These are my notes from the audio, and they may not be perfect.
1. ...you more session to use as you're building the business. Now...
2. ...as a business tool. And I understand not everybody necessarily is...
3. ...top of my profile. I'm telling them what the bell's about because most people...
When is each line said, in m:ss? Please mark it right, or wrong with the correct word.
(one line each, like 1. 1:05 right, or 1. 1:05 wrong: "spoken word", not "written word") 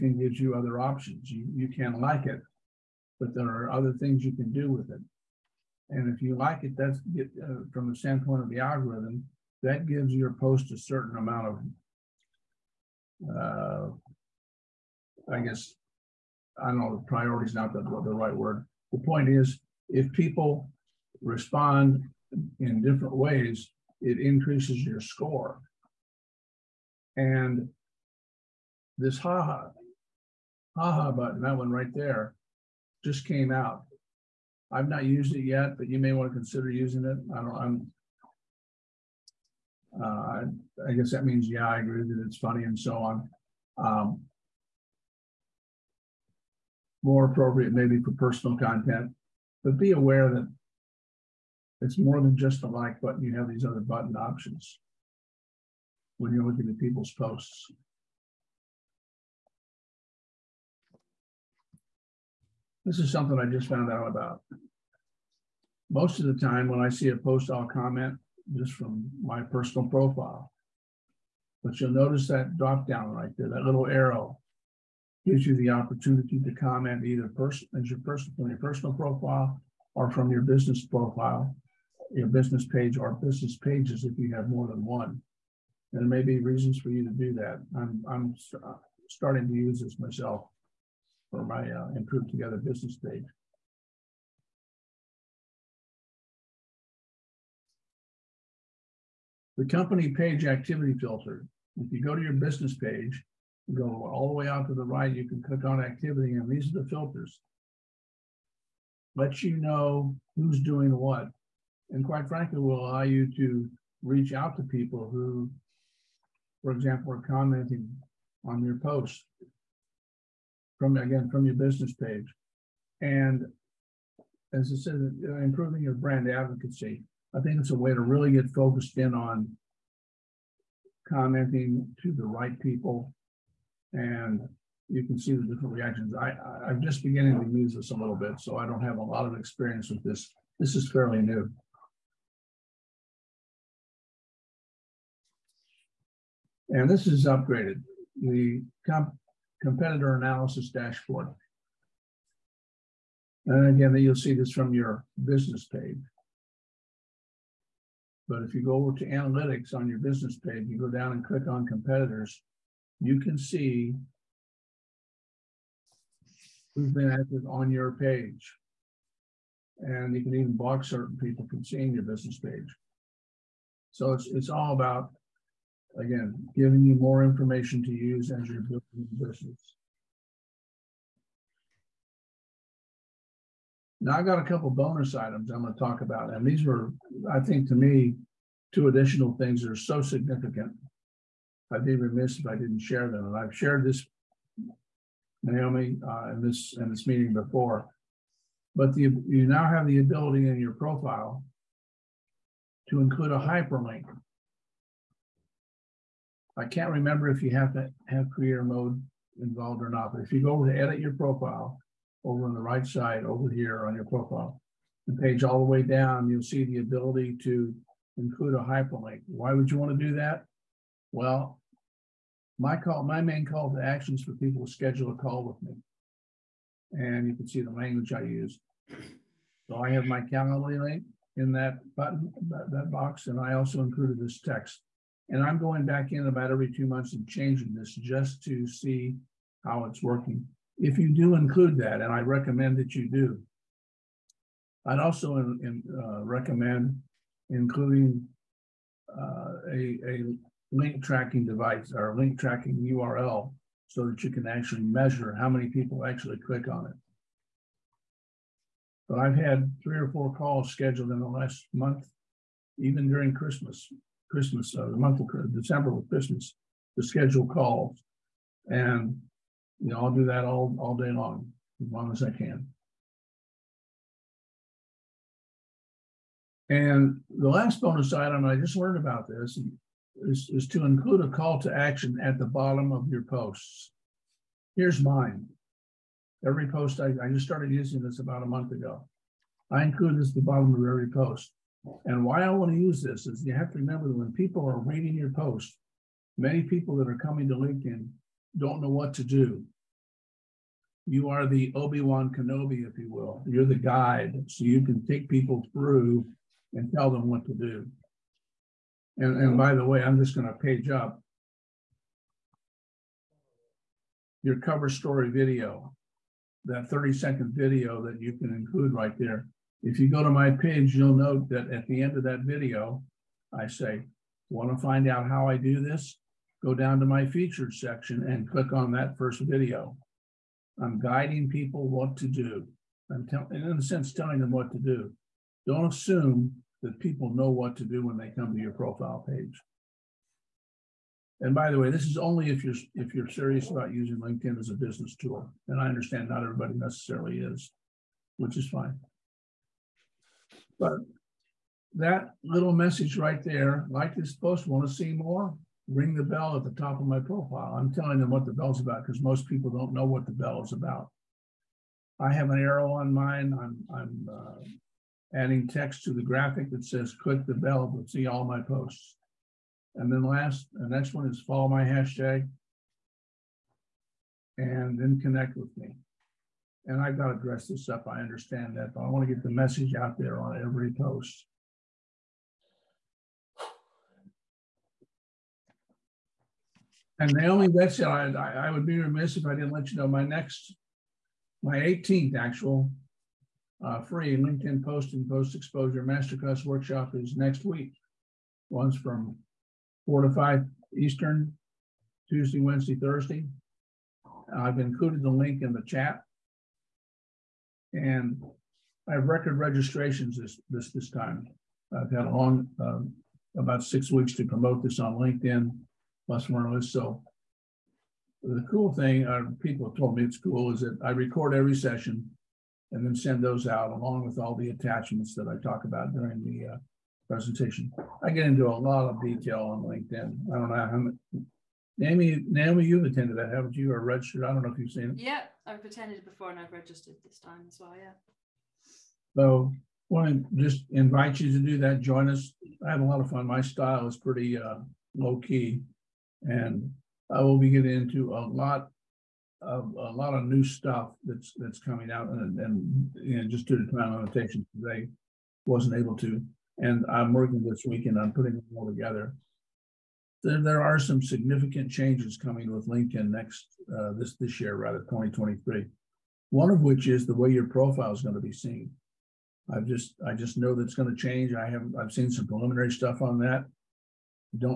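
1. 2:56 wrong: "information", not "session"
2. 5:44 right
3. 5:56 right.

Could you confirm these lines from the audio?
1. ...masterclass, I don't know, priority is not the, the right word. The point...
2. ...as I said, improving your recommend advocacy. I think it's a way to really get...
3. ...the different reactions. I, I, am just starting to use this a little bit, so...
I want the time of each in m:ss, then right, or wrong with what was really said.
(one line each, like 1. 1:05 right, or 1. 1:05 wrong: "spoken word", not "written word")
1. 0:15 wrong: "guess", not "masterclass"
2. 2:04 wrong: "brand", not "recommend"
3. 2:15 wrong: "beginning", not "starting".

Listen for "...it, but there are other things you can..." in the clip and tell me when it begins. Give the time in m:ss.
0:02.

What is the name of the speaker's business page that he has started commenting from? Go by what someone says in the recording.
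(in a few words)
Improve Together.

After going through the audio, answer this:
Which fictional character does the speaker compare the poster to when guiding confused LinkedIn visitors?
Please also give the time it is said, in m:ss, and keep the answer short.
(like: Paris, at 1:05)
Obi Wan Kenobi, at 5:01.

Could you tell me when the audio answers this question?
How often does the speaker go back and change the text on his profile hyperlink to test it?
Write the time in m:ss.
3:56.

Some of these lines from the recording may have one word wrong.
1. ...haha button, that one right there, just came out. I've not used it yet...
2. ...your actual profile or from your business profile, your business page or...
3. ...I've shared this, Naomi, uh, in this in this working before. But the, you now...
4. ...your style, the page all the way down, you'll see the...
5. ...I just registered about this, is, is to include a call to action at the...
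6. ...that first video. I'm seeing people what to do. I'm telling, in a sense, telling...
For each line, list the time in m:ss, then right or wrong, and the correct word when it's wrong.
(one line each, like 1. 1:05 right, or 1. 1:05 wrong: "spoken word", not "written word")
1. 0:30 right
2. 1:18 wrong: "personal", not "actual"
3. 3:13 wrong: "meeting", not "working"
4. 3:33 wrong: "profile", not "style"
5. 4:38 wrong: "learned", not "registered"
6. 5:28 wrong: "guiding", not "seeing".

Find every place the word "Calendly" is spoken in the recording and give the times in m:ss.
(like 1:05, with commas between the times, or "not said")
3:50.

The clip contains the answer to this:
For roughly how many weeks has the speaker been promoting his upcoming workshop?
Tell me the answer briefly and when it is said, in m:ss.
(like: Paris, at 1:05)
6 weeks, at 6:53.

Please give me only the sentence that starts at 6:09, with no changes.
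And then last, the next one is follow my hashtag and then connect with me and I've got to dress this up.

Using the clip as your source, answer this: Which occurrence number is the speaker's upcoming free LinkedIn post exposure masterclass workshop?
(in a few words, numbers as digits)
18th.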